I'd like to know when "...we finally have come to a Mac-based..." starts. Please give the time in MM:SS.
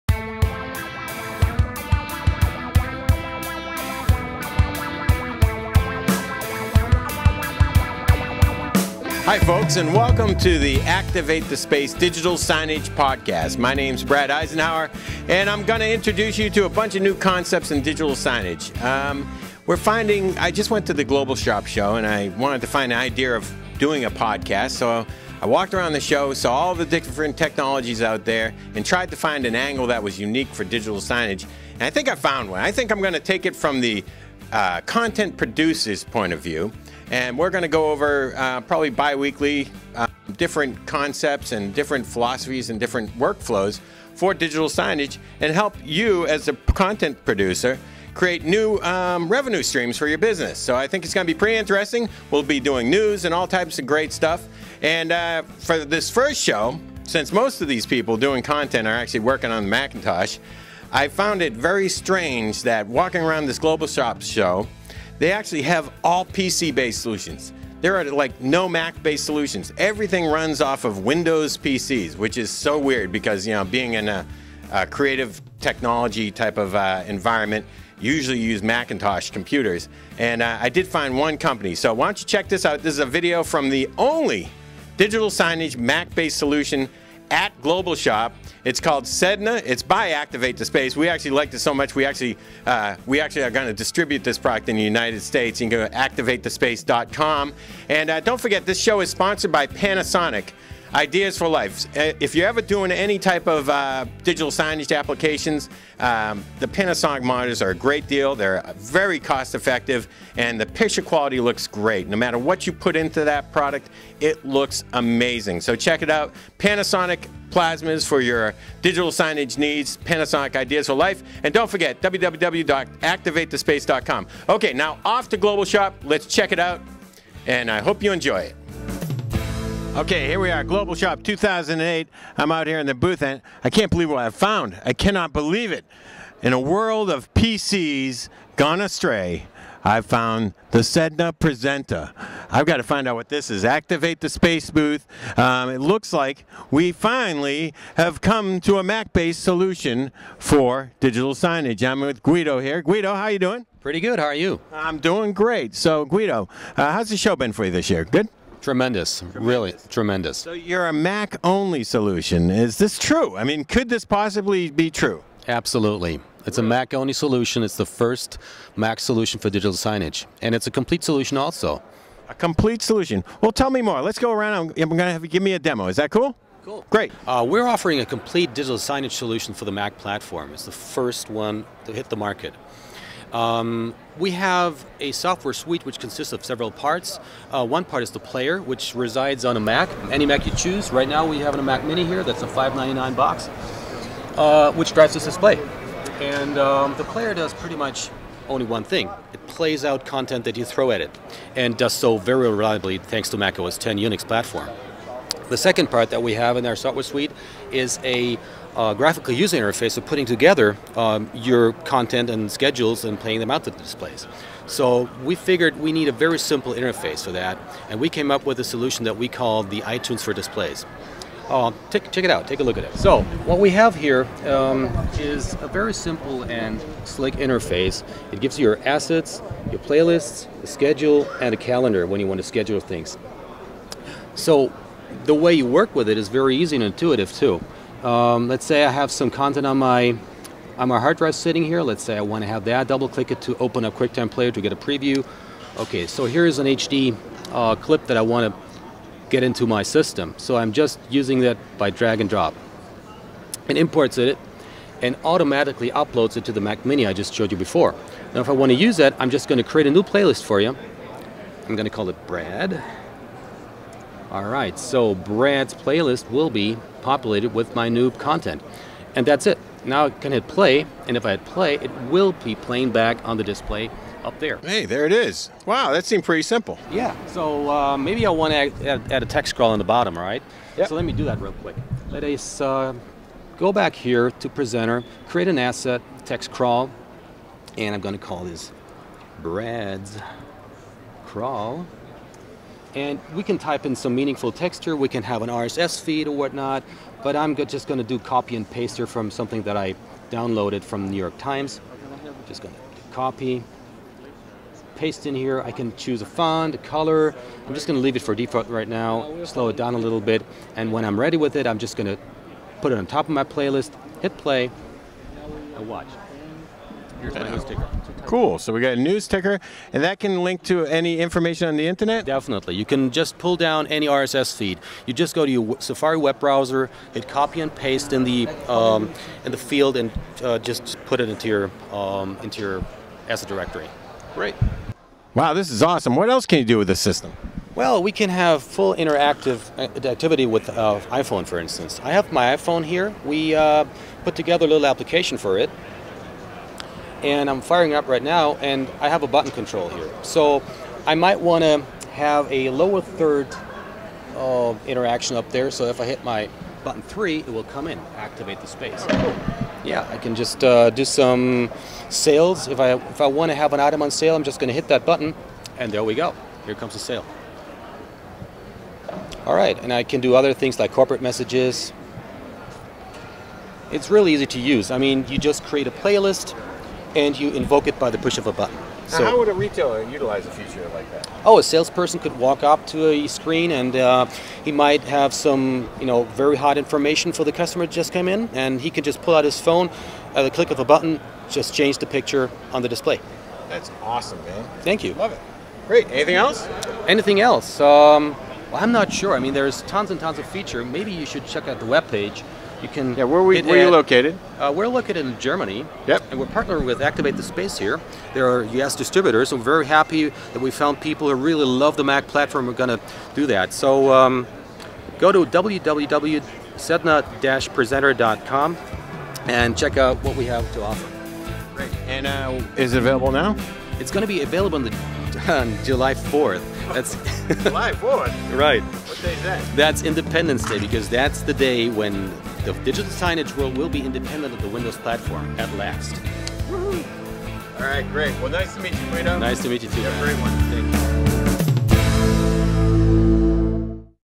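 02:26.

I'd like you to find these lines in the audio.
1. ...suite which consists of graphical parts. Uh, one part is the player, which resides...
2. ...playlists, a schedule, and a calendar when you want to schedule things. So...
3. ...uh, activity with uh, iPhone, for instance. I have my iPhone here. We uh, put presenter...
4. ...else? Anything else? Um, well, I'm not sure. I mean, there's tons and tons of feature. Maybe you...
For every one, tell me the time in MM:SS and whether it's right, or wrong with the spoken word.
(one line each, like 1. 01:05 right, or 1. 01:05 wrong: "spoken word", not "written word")
1. 03:05 wrong: "several", not "graphical"
2. 03:49 right
3. 05:39 wrong: "together", not "presenter"
4. 06:36 right.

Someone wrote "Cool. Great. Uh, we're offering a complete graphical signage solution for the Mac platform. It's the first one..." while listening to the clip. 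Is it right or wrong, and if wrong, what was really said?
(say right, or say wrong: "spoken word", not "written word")
wrong: "digital", not "graphical".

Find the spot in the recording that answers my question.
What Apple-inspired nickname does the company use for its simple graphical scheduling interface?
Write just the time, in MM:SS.
03:39.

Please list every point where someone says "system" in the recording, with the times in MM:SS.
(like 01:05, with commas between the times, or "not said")
04:09, 05:36.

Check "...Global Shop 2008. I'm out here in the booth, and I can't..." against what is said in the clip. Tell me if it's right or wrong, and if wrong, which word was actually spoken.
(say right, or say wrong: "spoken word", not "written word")
right.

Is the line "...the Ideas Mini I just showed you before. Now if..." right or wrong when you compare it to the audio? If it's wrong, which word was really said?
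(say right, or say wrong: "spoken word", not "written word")
wrong: "Mac", not "Ideas".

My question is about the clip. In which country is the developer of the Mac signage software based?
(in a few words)
Germany.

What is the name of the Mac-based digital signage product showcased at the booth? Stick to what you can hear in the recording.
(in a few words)
Sedna Presenter.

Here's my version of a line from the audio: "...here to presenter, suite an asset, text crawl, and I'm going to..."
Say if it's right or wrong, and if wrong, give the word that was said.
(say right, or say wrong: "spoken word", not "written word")
wrong: "create", not "suite".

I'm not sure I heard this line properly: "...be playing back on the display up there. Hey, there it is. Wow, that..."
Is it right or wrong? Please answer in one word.
right.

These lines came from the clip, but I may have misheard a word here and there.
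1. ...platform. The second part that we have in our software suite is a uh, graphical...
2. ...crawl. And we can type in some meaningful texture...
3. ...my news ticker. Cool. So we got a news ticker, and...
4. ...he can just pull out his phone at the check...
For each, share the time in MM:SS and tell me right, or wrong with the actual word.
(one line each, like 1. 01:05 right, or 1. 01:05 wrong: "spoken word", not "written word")
1. 03:24 right
2. 04:51 right
3. 05:17 right
4. 06:28 wrong: "click", not "check".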